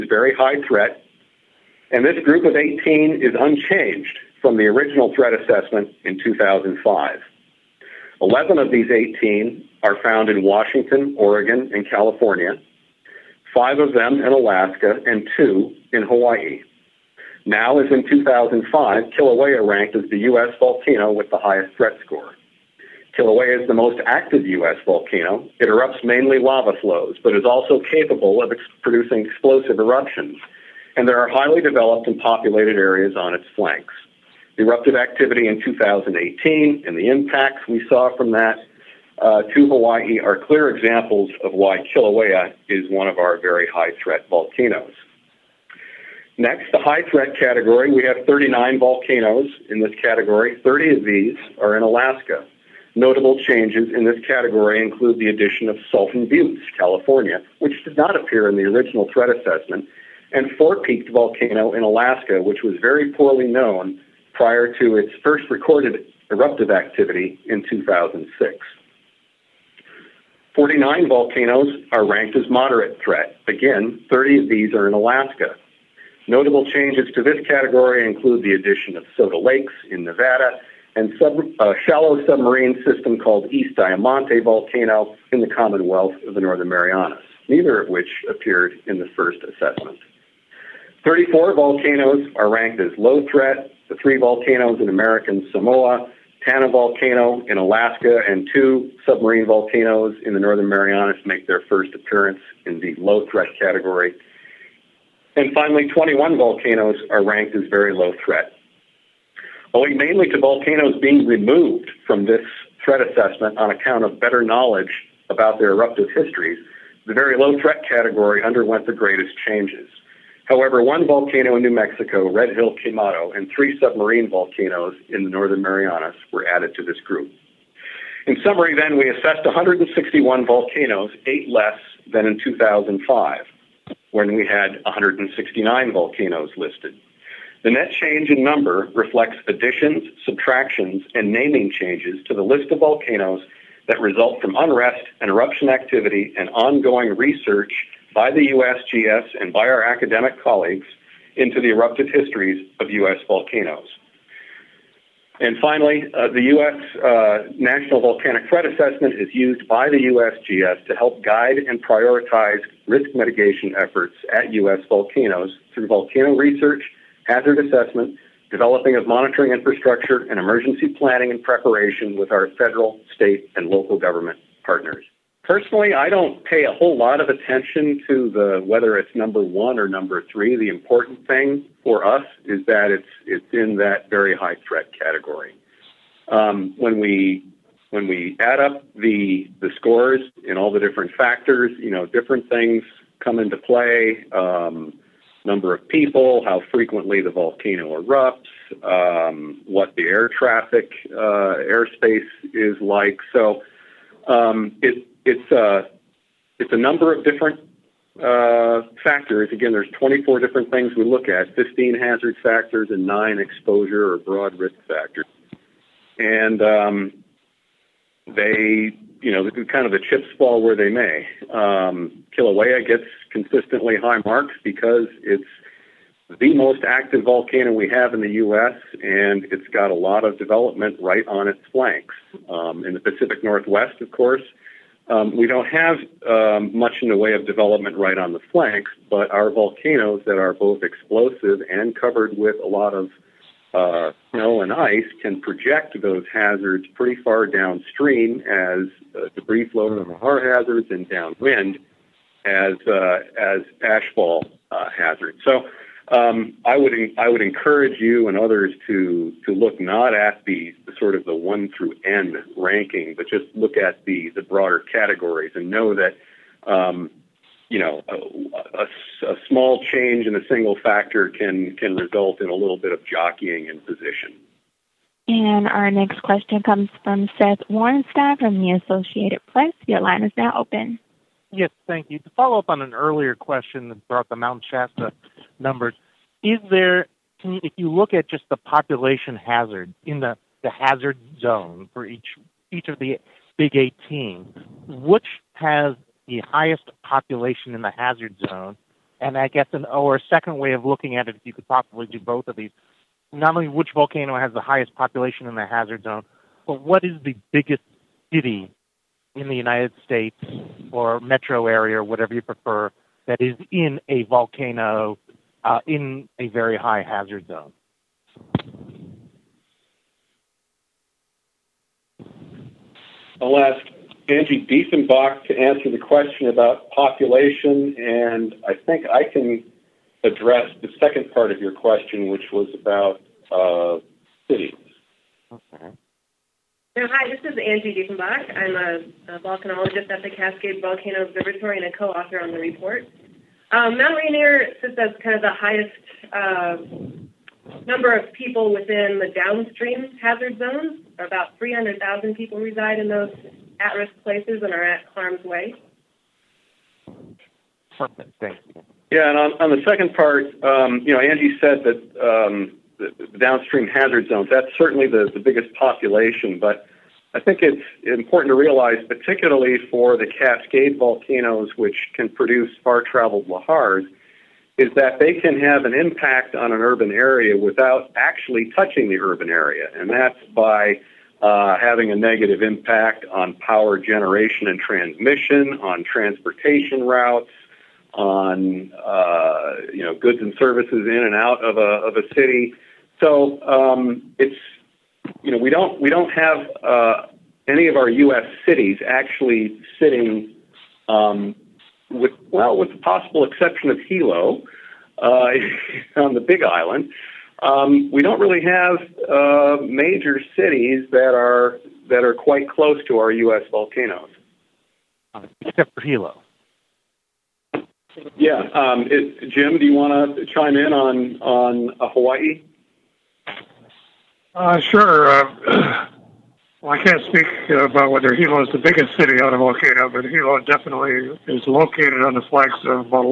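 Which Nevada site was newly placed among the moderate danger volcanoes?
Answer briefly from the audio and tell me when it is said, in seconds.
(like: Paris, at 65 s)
Soda Lakes, at 79 s.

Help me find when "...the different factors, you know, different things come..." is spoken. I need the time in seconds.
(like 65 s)
190 s.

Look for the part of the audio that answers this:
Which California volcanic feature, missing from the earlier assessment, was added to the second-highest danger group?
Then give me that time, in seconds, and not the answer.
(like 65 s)
55 s.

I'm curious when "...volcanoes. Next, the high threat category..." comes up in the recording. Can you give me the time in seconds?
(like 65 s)
44 s.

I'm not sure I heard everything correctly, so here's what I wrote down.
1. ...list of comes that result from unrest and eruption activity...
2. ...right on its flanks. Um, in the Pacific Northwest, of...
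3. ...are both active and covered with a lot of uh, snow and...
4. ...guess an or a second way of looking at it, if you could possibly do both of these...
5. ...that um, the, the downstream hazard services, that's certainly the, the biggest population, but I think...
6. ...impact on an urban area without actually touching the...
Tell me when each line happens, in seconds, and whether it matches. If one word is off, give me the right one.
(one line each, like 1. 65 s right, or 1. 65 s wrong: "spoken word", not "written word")
1. 142 s wrong: "volcanoes", not "comes"
2. 231 s right
3. 240 s wrong: "explosive", not "active"
4. 299 s right
5. 361 s wrong: "zones", not "services"
6. 375 s right.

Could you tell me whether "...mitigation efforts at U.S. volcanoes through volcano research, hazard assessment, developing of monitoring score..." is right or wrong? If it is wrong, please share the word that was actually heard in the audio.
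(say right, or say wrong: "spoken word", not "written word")
wrong: "infrastructure", not "score".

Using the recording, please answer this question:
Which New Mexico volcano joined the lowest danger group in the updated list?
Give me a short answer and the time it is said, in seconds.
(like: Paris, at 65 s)
Red Hill Quemado, at 122 s.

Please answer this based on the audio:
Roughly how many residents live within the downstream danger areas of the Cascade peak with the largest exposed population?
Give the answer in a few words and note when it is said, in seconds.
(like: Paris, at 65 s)
300,000, at 351 s.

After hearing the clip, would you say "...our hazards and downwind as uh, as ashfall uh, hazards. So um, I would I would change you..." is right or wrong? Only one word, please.
wrong.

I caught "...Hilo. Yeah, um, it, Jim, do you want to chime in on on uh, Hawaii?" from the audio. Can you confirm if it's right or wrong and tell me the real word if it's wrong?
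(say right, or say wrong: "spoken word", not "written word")
right.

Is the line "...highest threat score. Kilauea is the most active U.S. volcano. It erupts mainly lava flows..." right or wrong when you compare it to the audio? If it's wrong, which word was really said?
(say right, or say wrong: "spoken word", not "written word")
right.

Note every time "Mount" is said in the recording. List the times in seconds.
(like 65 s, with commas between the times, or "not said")
284 s, 343 s.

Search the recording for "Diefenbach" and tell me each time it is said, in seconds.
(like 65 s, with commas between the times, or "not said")
324 s, 338 s.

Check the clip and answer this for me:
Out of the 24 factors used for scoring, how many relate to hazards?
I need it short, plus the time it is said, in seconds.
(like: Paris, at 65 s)
15, at 211 s.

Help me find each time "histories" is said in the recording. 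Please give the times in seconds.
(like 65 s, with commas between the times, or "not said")
116 s, 152 s.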